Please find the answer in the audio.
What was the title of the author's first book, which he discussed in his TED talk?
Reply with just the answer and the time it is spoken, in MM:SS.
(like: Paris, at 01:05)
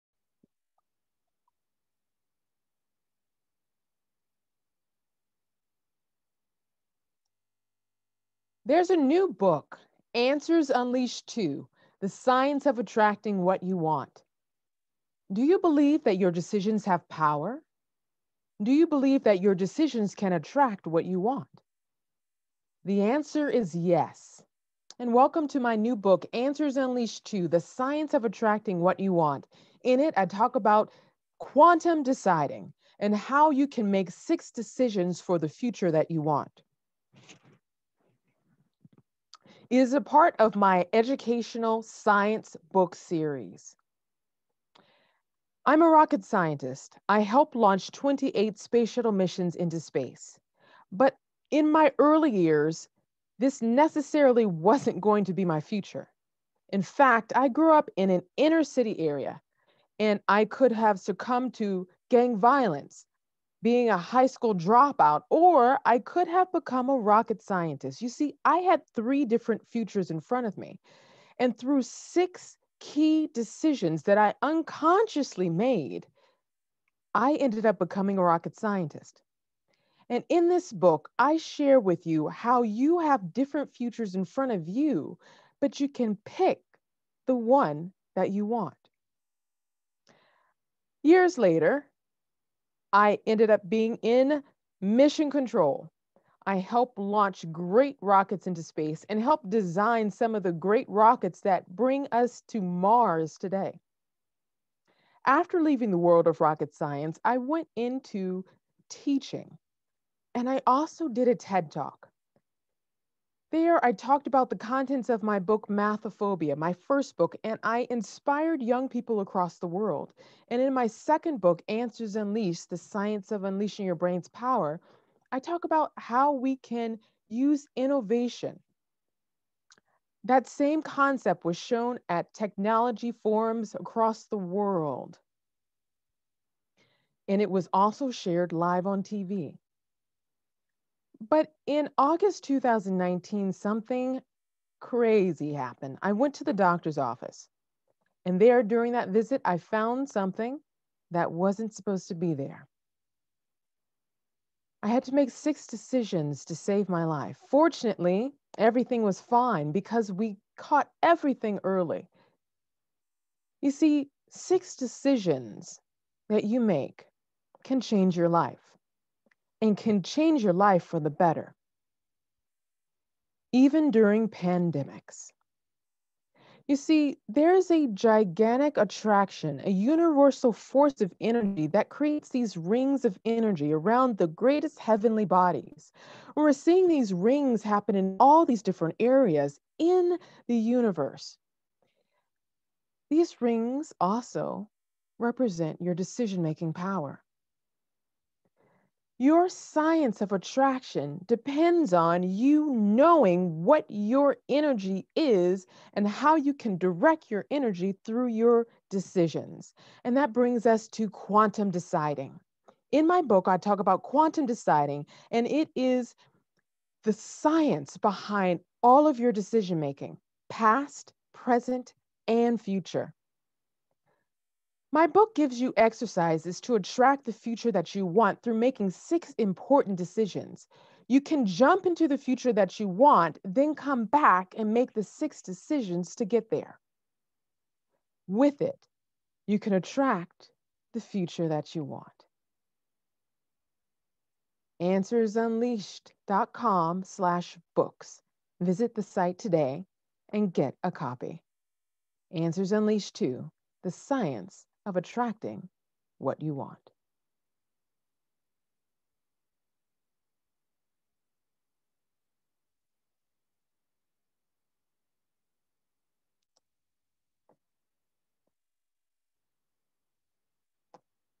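Mathophobia, at 01:55.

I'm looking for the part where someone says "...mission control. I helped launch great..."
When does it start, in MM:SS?
01:34.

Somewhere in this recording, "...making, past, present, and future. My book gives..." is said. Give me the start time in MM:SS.
03:39.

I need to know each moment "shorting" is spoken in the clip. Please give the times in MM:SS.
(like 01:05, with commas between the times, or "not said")
not said.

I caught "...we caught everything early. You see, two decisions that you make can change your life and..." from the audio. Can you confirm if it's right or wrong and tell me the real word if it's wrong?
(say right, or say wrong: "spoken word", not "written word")
wrong: "six", not "two".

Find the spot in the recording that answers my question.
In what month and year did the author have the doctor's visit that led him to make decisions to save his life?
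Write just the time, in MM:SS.
02:21.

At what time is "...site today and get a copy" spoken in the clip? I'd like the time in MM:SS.
04:09.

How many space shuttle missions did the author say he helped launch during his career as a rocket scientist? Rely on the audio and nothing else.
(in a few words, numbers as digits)
28.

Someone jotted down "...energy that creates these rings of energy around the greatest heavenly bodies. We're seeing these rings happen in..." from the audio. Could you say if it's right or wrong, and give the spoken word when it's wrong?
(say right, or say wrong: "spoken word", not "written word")
right.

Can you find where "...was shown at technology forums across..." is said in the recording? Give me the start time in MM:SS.
02:11.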